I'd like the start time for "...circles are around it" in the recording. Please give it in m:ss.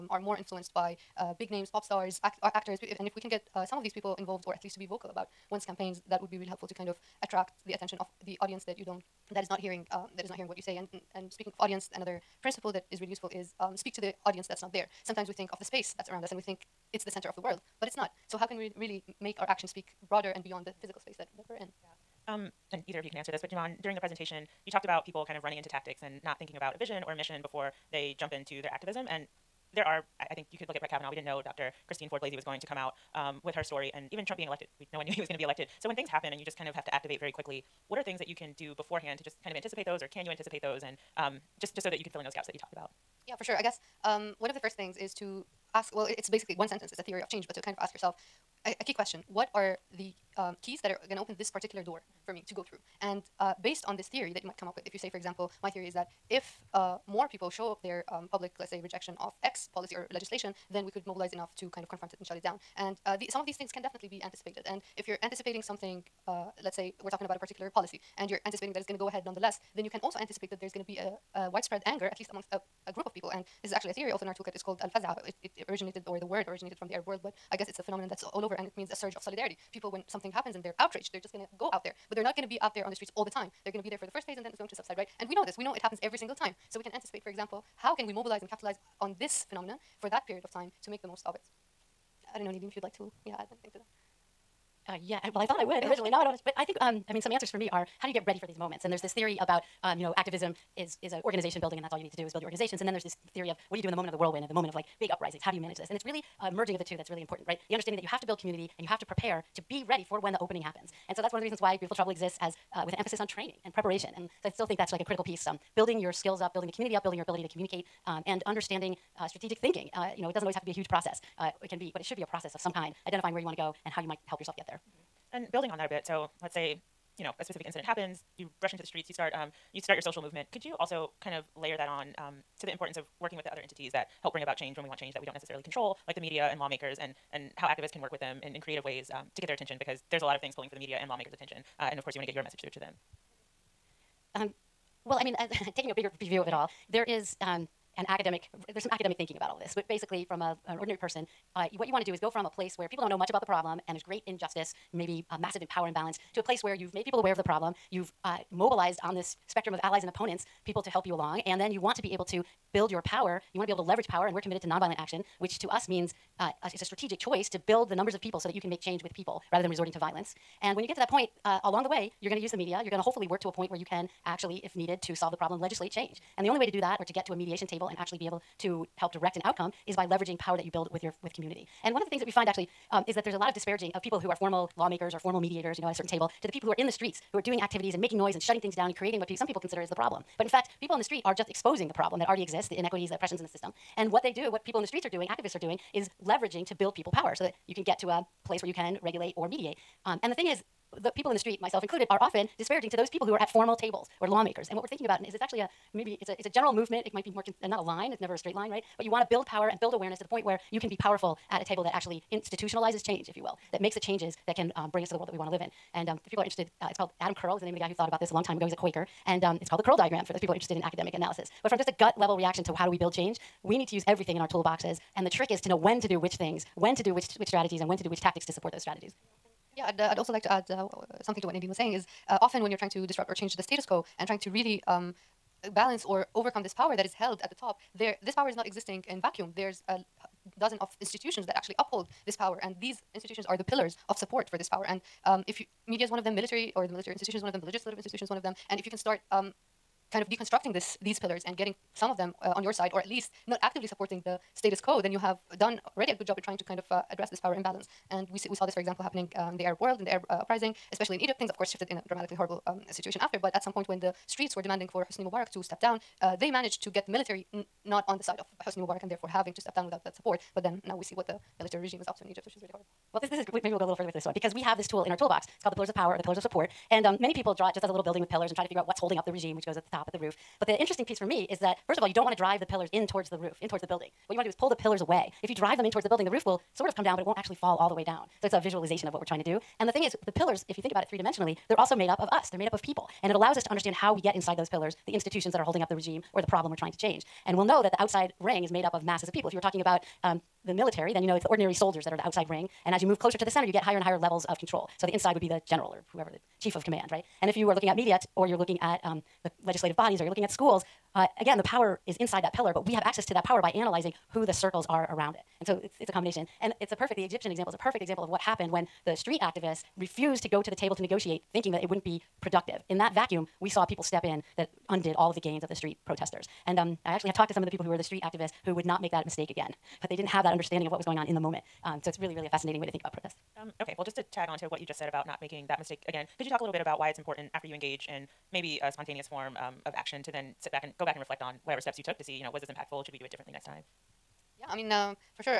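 5:14.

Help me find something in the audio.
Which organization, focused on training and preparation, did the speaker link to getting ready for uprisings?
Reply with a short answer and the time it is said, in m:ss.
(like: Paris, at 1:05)
Beautiful Trouble, at 1:51.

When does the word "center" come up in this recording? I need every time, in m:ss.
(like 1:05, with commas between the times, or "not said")
0:17, 5:03.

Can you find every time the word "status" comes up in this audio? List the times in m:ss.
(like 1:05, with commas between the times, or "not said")
3:53, 4:14.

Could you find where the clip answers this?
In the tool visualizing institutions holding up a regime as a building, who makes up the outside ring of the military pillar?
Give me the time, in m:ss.
5:01.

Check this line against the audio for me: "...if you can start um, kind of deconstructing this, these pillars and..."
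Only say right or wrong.
right.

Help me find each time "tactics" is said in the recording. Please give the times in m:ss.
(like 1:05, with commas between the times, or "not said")
0:25, 3:48.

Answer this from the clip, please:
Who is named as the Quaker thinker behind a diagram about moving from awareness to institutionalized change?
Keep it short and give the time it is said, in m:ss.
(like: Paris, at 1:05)
Adam Curle, at 3:37.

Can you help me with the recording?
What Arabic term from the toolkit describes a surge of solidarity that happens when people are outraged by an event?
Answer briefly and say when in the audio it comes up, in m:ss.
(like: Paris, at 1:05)
al-faz'a, at 1:14.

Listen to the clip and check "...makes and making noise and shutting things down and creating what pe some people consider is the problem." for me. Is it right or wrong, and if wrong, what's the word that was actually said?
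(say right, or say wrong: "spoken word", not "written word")
wrong: "activities", not "makes".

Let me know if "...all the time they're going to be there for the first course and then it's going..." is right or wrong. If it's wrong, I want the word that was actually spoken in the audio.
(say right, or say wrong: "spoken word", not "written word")
wrong: "phase", not "course".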